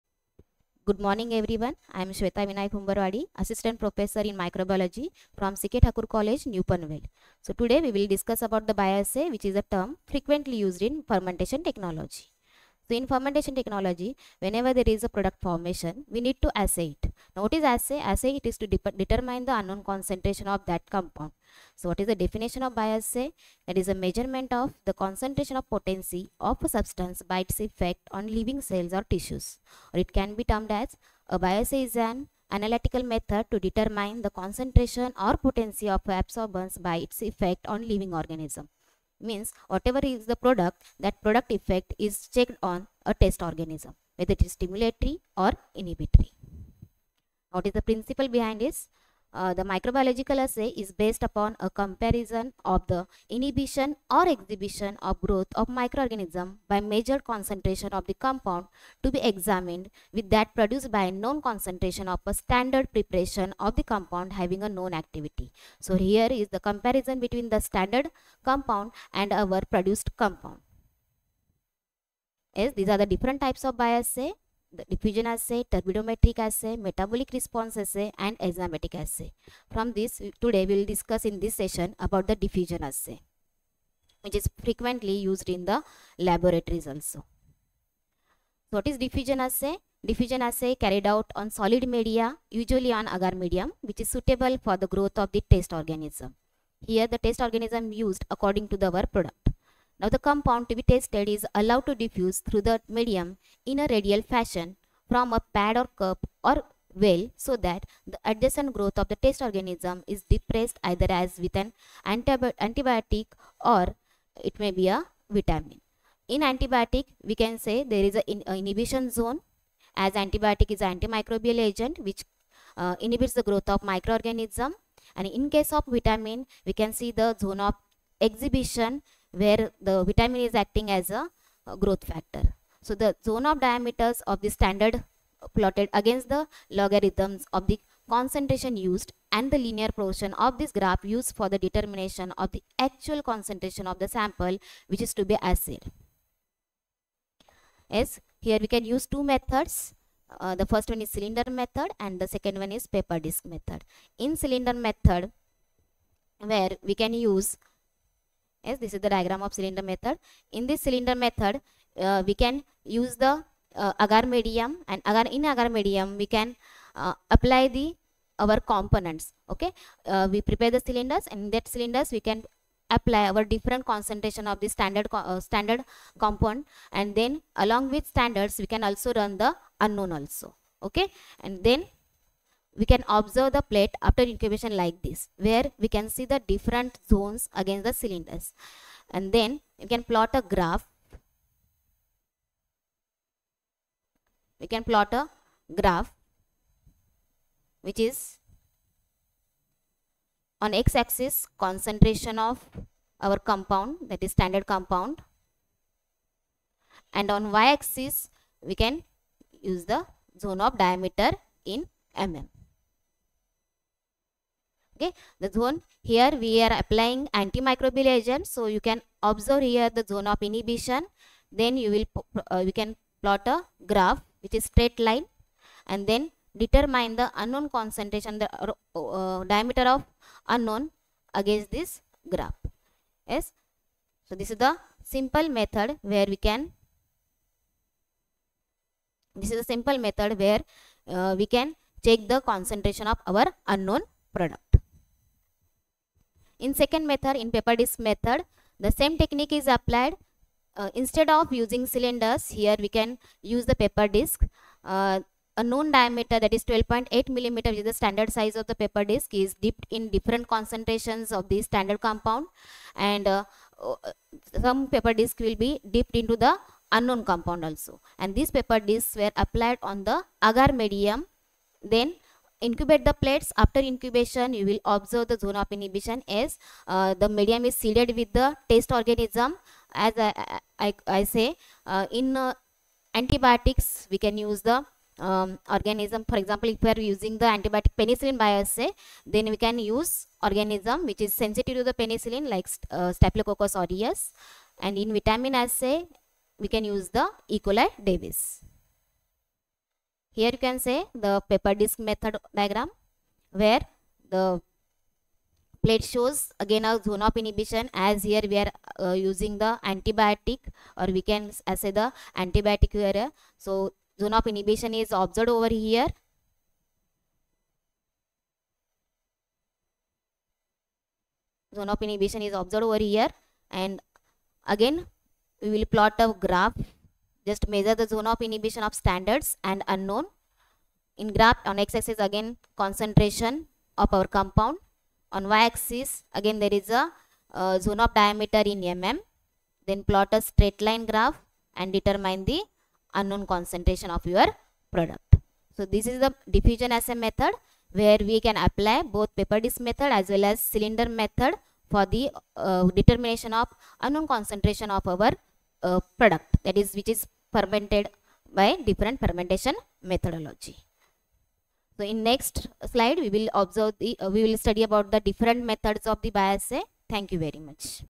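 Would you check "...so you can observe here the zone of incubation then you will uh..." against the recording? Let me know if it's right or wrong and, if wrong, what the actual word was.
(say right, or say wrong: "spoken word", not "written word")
wrong: "inhibition", not "incubation".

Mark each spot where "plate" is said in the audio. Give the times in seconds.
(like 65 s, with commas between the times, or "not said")
183 s, 273 s, 305 s.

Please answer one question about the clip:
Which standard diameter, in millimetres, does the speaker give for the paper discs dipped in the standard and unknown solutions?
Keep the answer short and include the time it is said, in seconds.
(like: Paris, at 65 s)
12.8, at 256 s.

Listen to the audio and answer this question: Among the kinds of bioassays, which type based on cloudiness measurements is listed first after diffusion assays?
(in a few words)
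Turbidometric assay.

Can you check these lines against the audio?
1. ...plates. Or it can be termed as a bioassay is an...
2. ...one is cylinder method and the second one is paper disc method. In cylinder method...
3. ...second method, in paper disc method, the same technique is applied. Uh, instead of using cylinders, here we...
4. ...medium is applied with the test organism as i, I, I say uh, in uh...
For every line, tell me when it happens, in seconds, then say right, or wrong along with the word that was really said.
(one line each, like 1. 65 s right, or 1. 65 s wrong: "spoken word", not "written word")
1. 29 s wrong: "tissues", not "plates"
2. 150 s right
3. 246 s right
4. 277 s wrong: "seeded", not "applied".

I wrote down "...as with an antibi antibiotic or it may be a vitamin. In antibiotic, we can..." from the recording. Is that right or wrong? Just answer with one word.
right.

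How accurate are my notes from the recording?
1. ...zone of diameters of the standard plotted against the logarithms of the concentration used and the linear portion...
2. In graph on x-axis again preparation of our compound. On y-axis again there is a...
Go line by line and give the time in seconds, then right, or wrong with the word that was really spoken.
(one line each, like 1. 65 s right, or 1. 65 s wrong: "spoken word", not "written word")
1. 133 s right
2. 331 s wrong: "concentration", not "preparation".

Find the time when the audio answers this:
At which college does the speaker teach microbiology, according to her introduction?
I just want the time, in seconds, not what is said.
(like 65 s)
5 s.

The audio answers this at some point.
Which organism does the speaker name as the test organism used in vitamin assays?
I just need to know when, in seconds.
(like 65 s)
297 s.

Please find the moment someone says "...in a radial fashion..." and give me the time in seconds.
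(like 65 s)
103 s.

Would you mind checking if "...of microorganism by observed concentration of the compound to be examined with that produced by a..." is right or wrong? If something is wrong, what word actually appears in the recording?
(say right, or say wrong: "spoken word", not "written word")
wrong: "measured", not "observed".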